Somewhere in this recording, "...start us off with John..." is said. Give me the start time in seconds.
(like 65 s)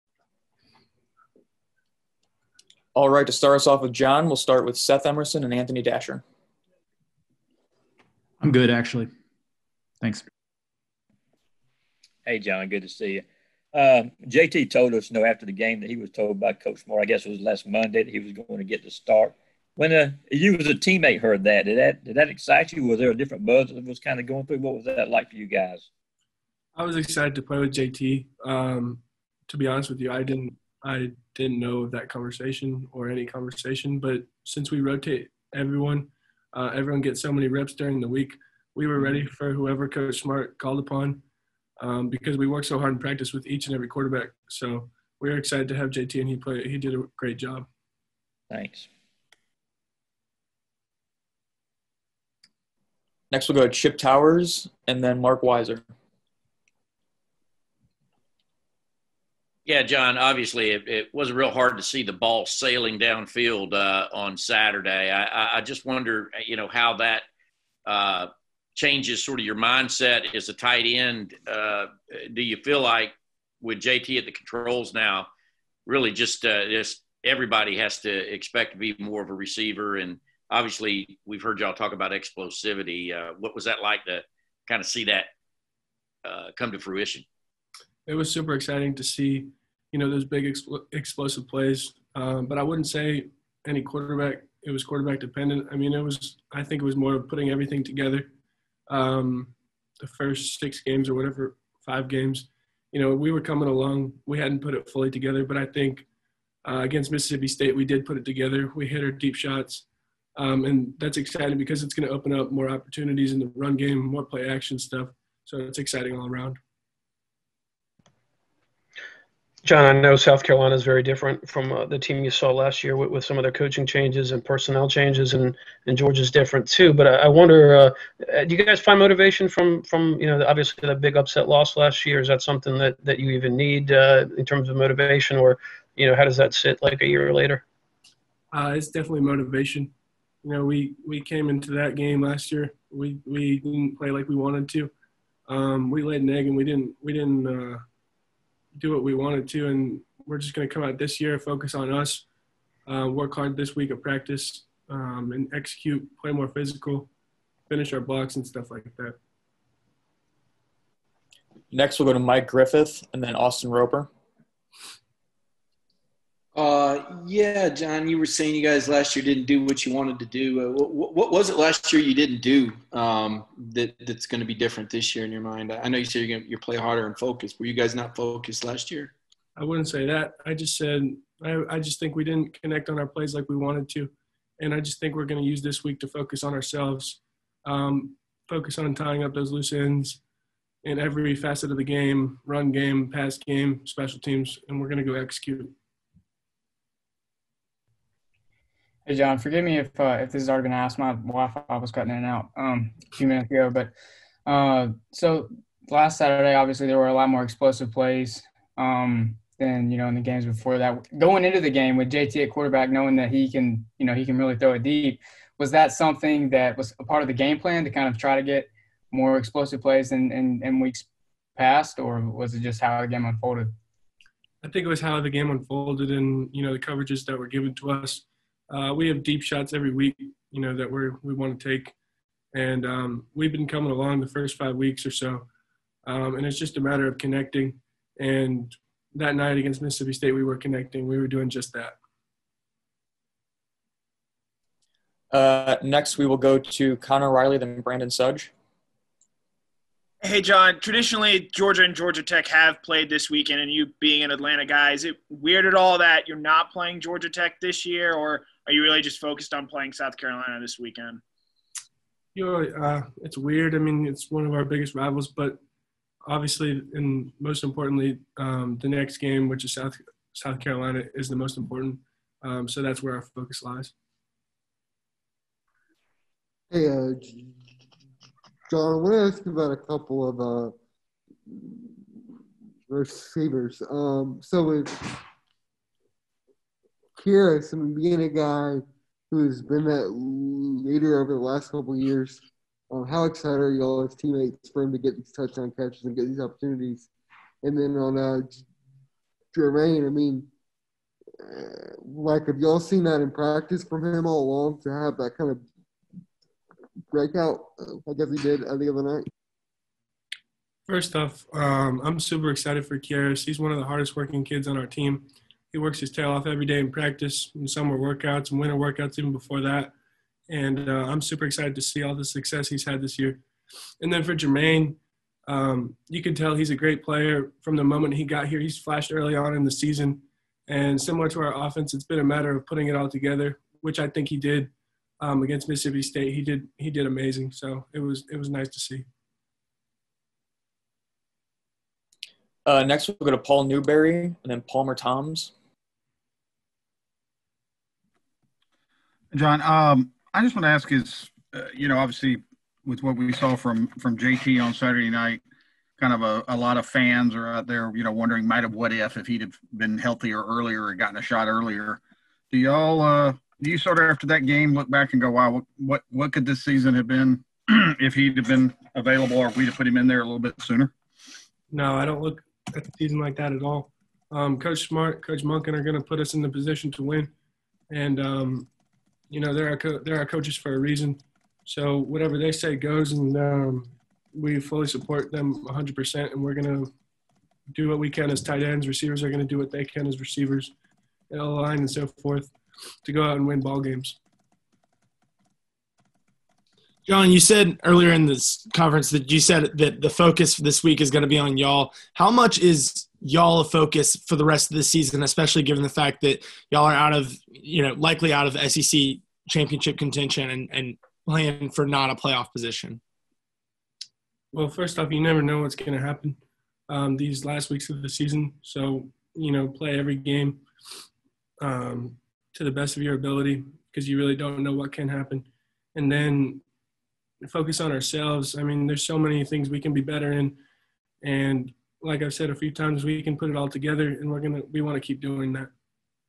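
3 s.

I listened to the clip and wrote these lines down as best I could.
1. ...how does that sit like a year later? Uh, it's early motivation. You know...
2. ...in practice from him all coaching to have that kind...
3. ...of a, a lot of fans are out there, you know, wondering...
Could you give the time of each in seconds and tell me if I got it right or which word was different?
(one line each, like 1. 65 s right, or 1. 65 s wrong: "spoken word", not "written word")
1. 136 s wrong: "definitely", not "early"
2. 303 s wrong: "along", not "coaching"
3. 356 s right.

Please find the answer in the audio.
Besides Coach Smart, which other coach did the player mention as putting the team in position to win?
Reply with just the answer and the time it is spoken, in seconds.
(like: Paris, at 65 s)
Coach Munkin, at 375 s.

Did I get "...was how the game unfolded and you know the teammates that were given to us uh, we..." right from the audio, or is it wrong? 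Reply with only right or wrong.
wrong.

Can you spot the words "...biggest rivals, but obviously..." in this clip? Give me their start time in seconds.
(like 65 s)
264 s.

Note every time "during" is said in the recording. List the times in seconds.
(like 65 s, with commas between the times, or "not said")
37 s.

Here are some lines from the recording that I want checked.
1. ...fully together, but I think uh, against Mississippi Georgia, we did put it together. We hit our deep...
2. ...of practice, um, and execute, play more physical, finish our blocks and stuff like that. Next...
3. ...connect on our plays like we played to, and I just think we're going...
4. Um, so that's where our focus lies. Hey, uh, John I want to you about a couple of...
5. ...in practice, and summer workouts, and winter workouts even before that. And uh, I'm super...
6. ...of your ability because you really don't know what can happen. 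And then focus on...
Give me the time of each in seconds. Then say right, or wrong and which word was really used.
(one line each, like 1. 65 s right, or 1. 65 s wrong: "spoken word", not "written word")
1. 104 s wrong: "State", not "Georgia"
2. 153 s right
3. 182 s wrong: "wanted", not "played"
4. 272 s right
5. 316 s right
6. 422 s right.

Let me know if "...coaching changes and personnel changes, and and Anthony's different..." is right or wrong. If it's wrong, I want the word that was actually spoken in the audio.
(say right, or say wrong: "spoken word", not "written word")
wrong: "Georgia", not "Anthony".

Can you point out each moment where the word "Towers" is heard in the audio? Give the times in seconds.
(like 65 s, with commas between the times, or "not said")
53 s.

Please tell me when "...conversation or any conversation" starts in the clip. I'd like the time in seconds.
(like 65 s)
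32 s.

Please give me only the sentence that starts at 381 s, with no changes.
So whatever they say goes, and um, we fully support them 100%.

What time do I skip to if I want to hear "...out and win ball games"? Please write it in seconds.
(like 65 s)
393 s.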